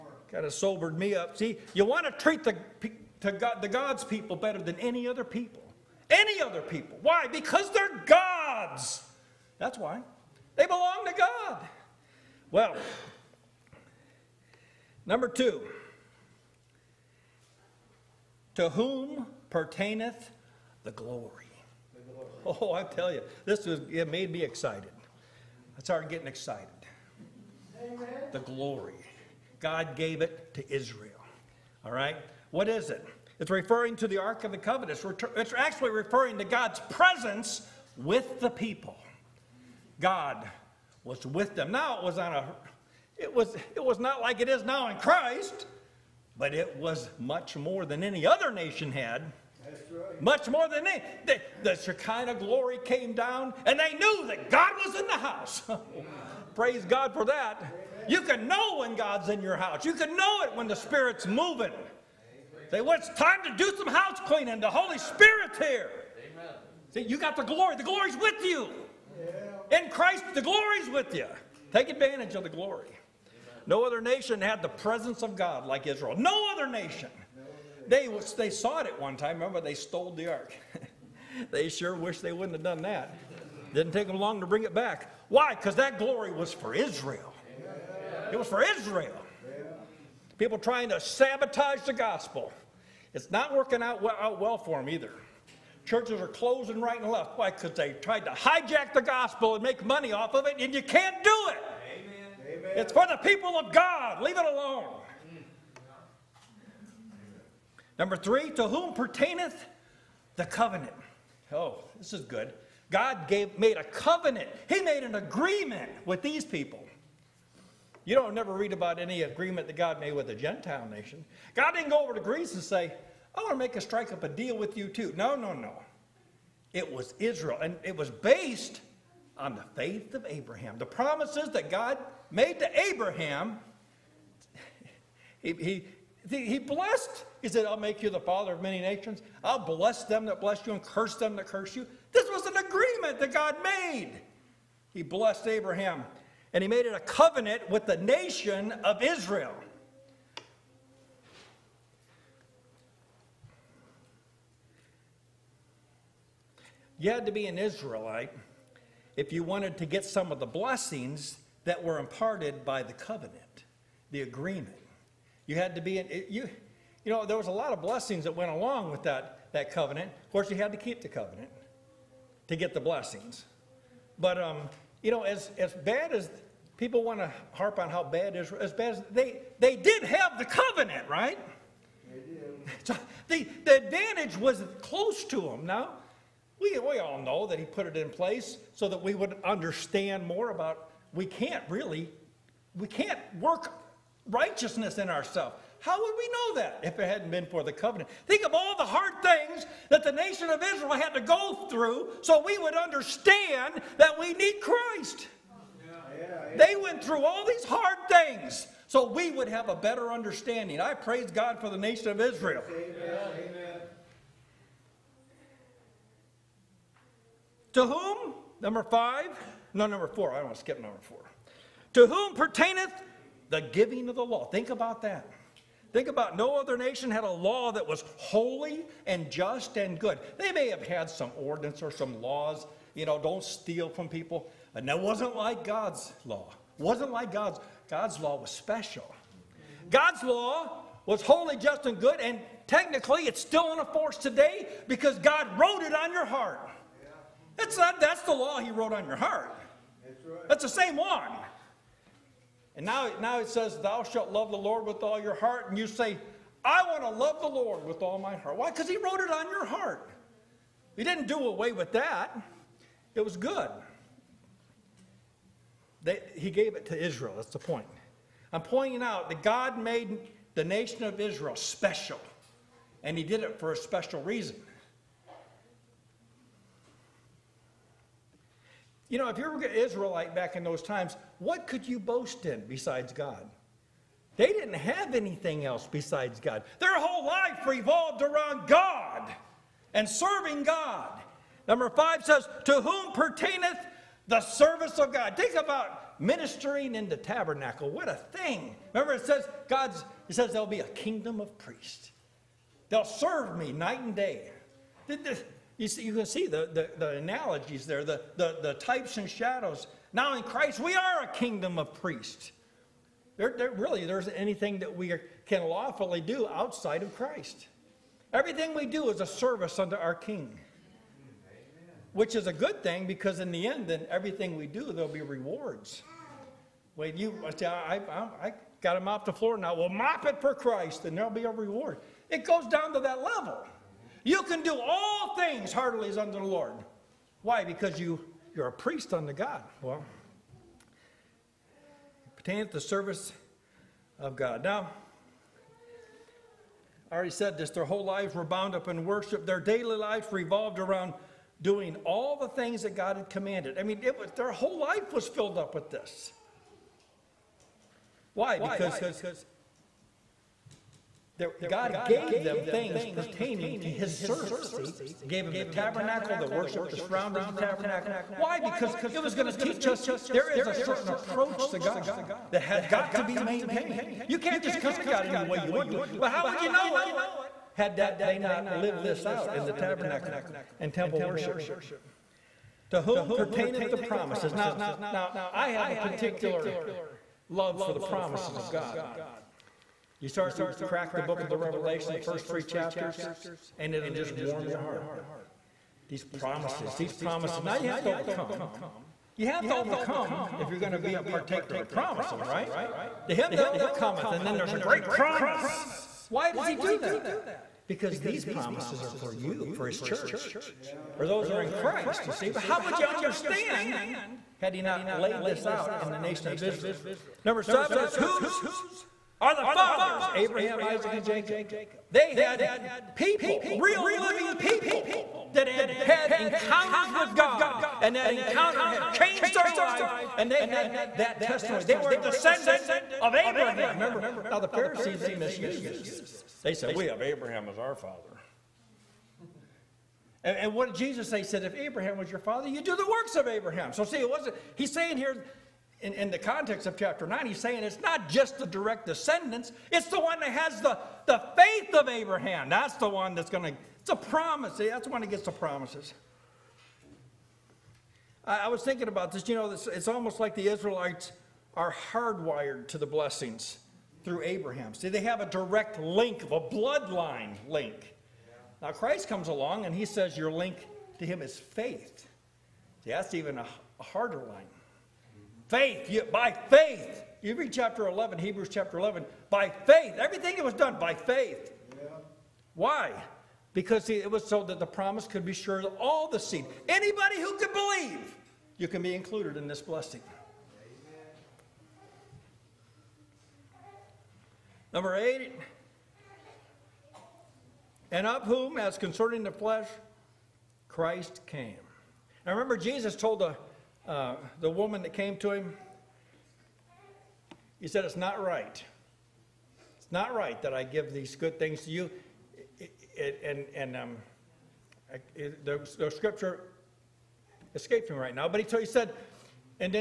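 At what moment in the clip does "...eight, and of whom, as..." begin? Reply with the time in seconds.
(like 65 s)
495 s.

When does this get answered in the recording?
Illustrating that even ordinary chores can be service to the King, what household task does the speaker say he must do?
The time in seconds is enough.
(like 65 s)
329 s.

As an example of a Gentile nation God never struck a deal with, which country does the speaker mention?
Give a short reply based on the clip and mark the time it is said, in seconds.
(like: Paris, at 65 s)
Greece, at 122 s.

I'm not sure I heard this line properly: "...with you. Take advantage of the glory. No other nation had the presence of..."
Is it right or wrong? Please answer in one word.
right.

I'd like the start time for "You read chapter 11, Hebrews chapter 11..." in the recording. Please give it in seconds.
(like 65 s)
477 s.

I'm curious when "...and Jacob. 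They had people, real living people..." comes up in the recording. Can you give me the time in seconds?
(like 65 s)
421 s.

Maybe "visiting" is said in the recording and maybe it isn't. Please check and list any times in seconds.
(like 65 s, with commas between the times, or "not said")
not said.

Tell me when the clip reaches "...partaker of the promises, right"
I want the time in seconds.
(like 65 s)
401 s.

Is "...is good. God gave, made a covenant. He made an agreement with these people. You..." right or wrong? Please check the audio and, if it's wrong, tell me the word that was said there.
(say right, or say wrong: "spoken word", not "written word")
right.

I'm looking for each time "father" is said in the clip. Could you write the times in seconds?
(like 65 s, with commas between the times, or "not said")
138 s, 419 s, 437 s, 442 s.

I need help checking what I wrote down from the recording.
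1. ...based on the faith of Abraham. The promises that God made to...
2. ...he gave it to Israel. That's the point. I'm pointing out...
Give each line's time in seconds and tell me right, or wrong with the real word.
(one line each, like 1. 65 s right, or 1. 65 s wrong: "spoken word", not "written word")
1. 128 s right
2. 266 s right.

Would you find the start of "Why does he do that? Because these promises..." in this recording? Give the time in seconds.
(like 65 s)
406 s.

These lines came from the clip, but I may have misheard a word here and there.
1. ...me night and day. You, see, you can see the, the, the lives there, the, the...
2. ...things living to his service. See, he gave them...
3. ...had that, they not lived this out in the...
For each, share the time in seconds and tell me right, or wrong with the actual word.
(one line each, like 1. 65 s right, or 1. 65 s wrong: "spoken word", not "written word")
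1. 303 s wrong: "analogies", not "lives"
2. 362 s wrong: "pertaining", not "living"
3. 377 s right.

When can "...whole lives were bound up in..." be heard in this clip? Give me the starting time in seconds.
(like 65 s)
347 s.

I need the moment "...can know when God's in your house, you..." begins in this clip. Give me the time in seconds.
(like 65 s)
58 s.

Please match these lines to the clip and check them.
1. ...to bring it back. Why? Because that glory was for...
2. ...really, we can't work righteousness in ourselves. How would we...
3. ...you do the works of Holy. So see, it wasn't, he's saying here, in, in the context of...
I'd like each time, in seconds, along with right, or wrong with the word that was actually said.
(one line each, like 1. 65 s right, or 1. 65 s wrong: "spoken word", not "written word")
1. 84 s right
2. 191 s right
3. 442 s wrong: "Abraham", not "Holy".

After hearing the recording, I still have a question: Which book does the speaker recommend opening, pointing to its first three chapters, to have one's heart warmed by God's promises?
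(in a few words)
Revelation.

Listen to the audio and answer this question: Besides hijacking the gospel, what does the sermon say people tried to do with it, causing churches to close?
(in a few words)
make money off of it.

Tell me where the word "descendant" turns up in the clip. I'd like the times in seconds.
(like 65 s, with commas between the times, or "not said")
432 s, 449 s.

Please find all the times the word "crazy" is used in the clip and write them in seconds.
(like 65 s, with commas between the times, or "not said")
not said.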